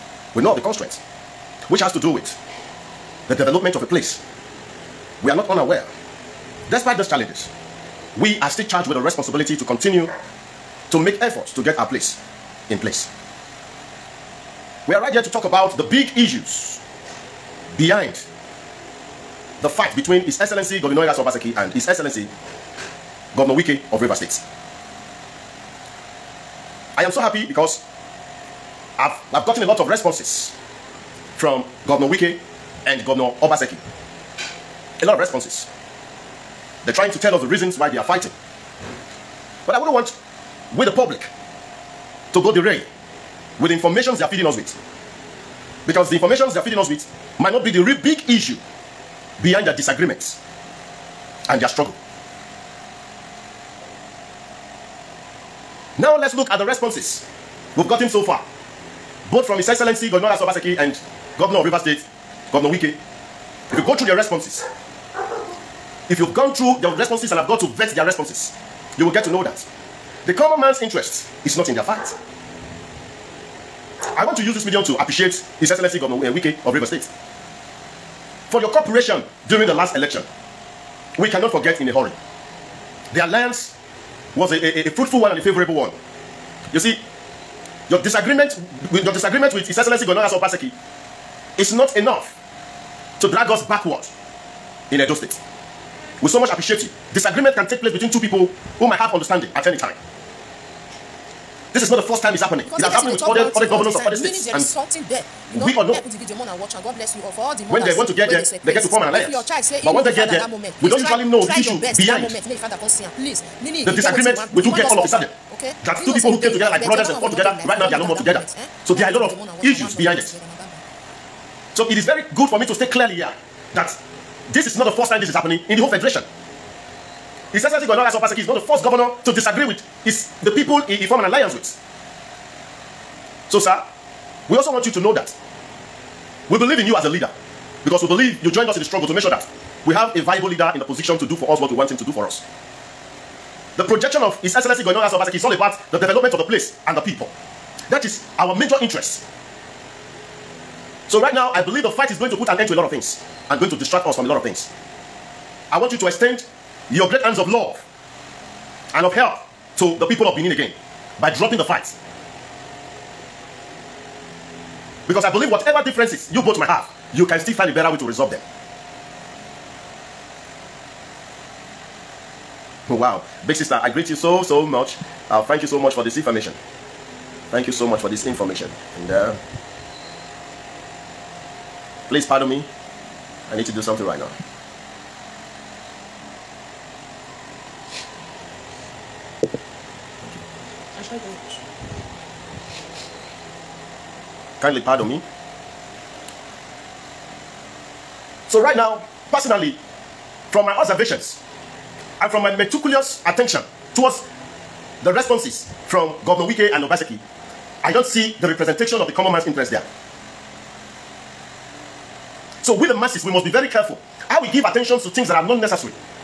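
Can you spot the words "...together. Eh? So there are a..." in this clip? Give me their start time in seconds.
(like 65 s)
118 s.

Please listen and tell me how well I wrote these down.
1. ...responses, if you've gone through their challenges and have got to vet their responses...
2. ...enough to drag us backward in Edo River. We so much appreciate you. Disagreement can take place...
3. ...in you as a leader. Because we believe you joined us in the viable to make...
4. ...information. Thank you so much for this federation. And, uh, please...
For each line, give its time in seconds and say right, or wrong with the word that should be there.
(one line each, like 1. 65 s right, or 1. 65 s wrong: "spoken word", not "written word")
1. 64 s wrong: "responses", not "challenges"
2. 91 s wrong: "State", not "River"
3. 136 s wrong: "struggle", not "viable"
4. 176 s wrong: "information", not "federation".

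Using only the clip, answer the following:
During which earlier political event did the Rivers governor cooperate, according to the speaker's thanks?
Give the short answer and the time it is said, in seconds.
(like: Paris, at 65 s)
the last election, at 79 s.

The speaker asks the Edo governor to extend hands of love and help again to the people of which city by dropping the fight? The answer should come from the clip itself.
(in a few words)
Benin.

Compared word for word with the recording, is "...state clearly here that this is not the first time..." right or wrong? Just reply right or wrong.
right.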